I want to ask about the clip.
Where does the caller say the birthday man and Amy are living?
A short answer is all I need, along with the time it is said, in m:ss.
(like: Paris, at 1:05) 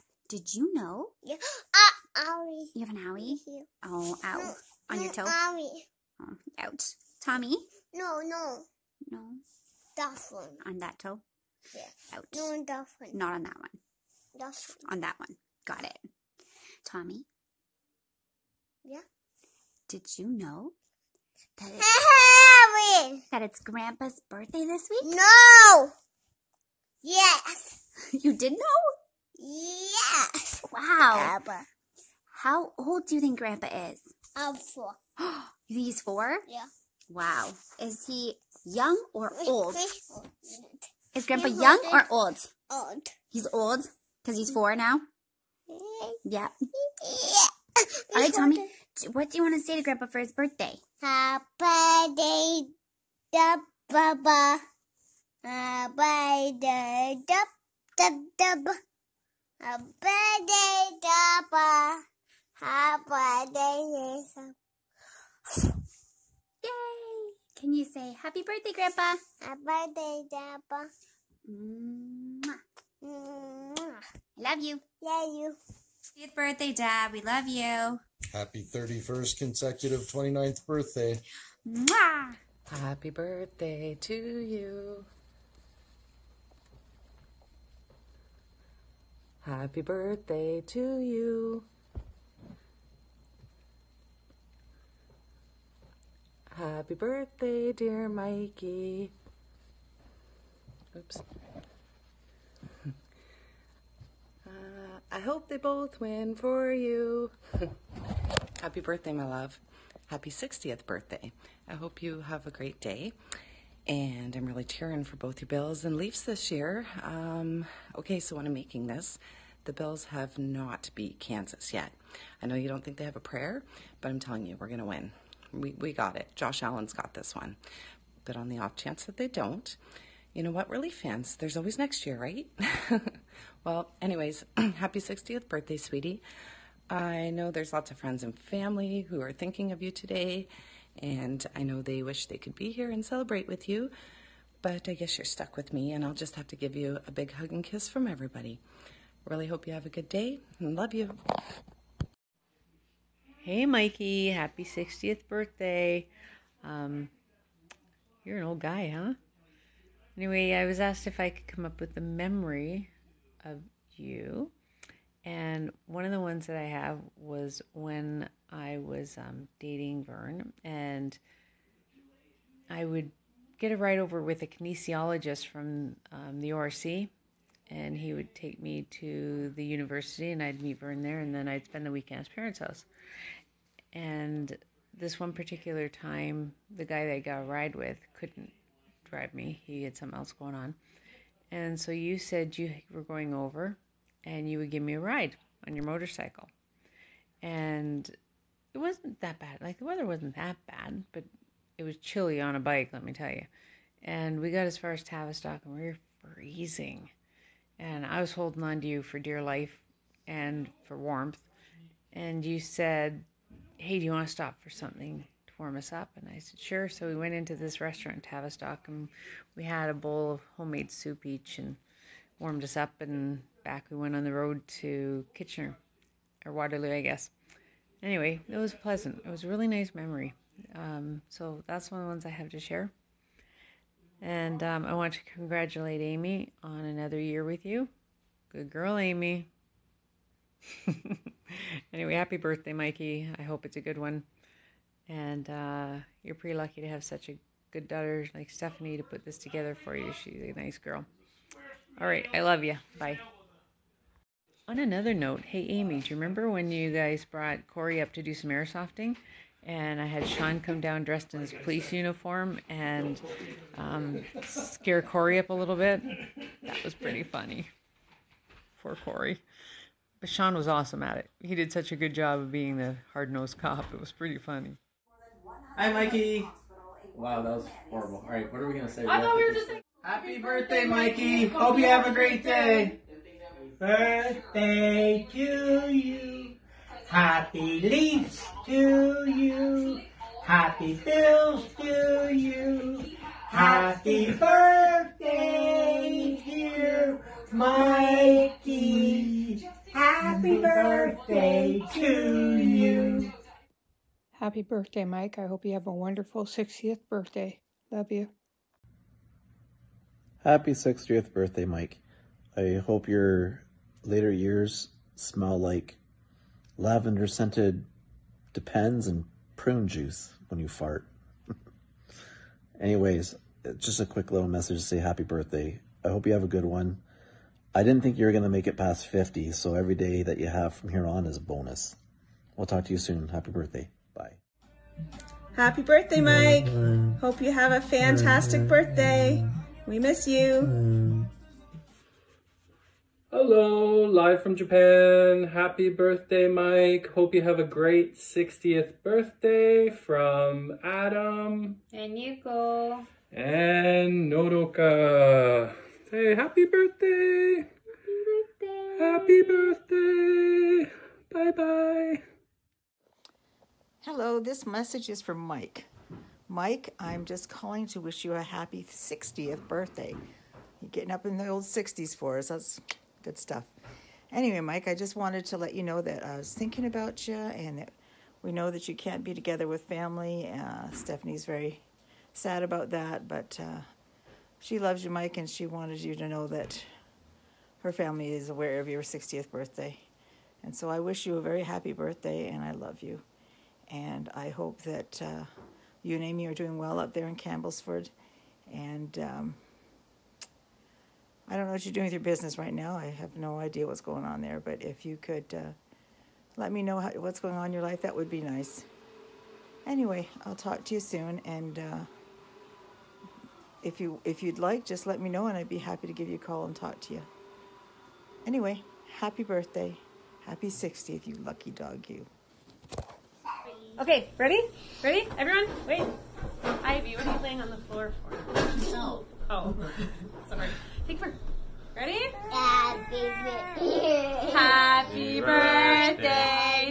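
Campbellford, at 6:37.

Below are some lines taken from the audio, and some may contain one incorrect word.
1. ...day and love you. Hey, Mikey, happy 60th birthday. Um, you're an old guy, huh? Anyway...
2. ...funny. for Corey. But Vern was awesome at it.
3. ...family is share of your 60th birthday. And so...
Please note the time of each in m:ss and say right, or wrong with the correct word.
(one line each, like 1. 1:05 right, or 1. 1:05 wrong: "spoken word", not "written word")
1. 2:30 right
2. 4:27 wrong: "Sean", not "Vern"
3. 6:27 wrong: "aware", not "share".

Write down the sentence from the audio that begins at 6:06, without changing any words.
Mike, I'm just calling to wish you a happy 60th birthday.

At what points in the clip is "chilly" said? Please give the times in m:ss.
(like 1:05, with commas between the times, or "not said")
3:21.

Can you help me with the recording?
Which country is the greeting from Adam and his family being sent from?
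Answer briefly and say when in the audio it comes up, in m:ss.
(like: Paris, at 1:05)
Japan, at 5:44.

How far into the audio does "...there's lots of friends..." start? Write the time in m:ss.
2:17.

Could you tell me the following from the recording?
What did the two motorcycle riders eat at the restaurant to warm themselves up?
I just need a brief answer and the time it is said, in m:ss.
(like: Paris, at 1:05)
homemade soup, at 3:40.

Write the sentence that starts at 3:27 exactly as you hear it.
And I was holding on to you for dear life and for warmth.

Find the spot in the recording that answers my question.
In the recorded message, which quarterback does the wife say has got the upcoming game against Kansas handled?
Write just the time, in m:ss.
2:06.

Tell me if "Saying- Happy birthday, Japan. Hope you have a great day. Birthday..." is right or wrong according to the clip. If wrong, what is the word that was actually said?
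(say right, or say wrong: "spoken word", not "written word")
wrong: "Mikey", not "Japan".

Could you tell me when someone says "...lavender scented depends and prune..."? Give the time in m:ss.
5:16.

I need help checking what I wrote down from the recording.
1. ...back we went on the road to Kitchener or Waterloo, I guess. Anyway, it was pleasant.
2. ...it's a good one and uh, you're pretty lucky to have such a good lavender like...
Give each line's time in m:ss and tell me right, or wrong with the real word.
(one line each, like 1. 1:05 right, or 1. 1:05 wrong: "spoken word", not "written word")
1. 3:43 right
2. 4:03 wrong: "daughter", not "lavender".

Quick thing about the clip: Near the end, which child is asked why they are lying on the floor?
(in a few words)
Ivy.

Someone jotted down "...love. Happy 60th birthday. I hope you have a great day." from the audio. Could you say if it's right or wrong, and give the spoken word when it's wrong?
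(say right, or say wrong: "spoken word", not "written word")
right.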